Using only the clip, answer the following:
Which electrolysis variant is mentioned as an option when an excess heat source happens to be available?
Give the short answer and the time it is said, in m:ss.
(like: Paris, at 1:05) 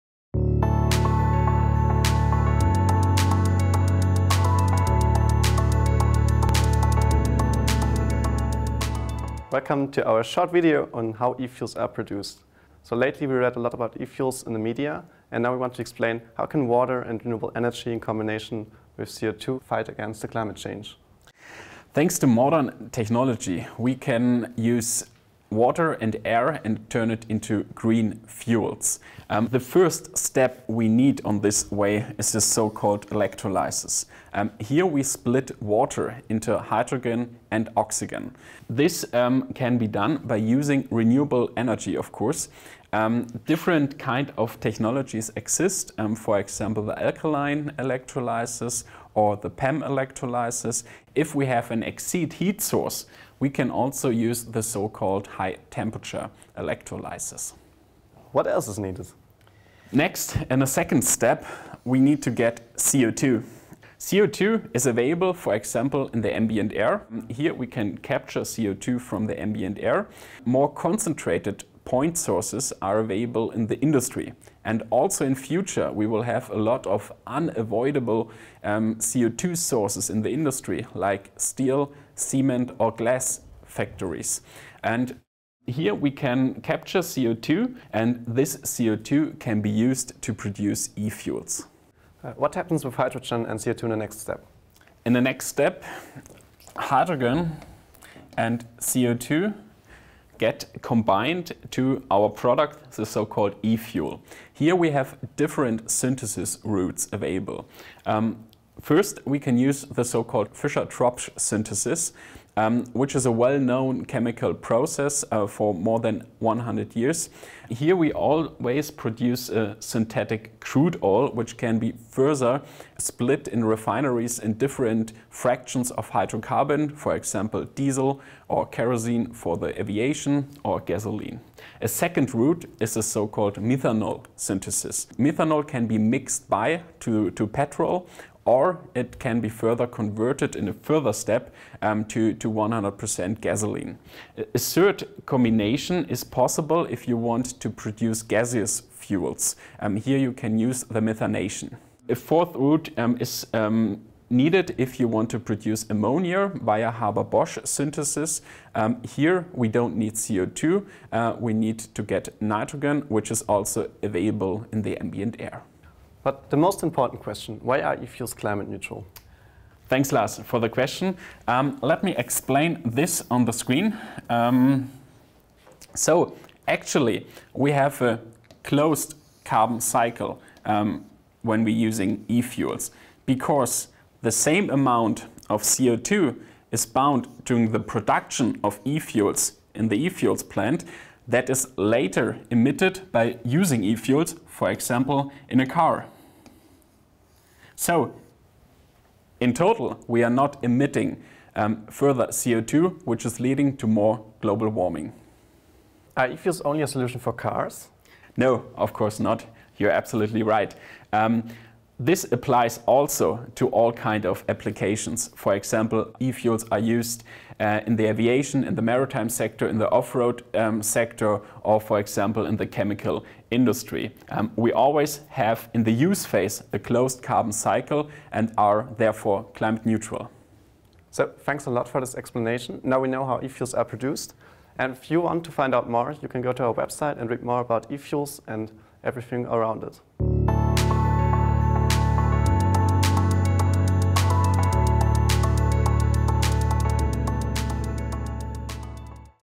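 High temperature electrolysis, at 0:55.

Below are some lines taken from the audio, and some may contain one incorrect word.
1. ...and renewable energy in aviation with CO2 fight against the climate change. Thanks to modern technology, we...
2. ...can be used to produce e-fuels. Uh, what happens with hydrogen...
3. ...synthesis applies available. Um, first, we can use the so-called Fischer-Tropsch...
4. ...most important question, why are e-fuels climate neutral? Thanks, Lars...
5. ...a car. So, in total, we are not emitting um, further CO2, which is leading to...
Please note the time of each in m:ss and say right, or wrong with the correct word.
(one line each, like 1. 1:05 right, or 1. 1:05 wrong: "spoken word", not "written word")
1. 0:17 wrong: "combination", not "aviation"
2. 1:29 right
3. 1:45 wrong: "routes", not "applies"
4. 2:46 right
5. 3:15 right.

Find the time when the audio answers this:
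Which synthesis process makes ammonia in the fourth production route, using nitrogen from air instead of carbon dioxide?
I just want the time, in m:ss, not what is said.
2:36.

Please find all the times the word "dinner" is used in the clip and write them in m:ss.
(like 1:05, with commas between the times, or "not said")
not said.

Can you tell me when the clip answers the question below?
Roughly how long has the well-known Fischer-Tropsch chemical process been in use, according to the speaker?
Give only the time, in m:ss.
1:55.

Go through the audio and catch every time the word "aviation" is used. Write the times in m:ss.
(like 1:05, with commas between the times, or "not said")
2:09, 3:38.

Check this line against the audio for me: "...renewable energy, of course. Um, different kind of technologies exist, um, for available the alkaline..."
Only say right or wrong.
wrong.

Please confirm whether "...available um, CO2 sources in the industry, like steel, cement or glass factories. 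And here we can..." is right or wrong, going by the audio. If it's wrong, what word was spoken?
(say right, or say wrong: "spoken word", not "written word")
wrong: "unavoidable", not "available".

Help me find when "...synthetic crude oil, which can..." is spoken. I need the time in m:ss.
1:59.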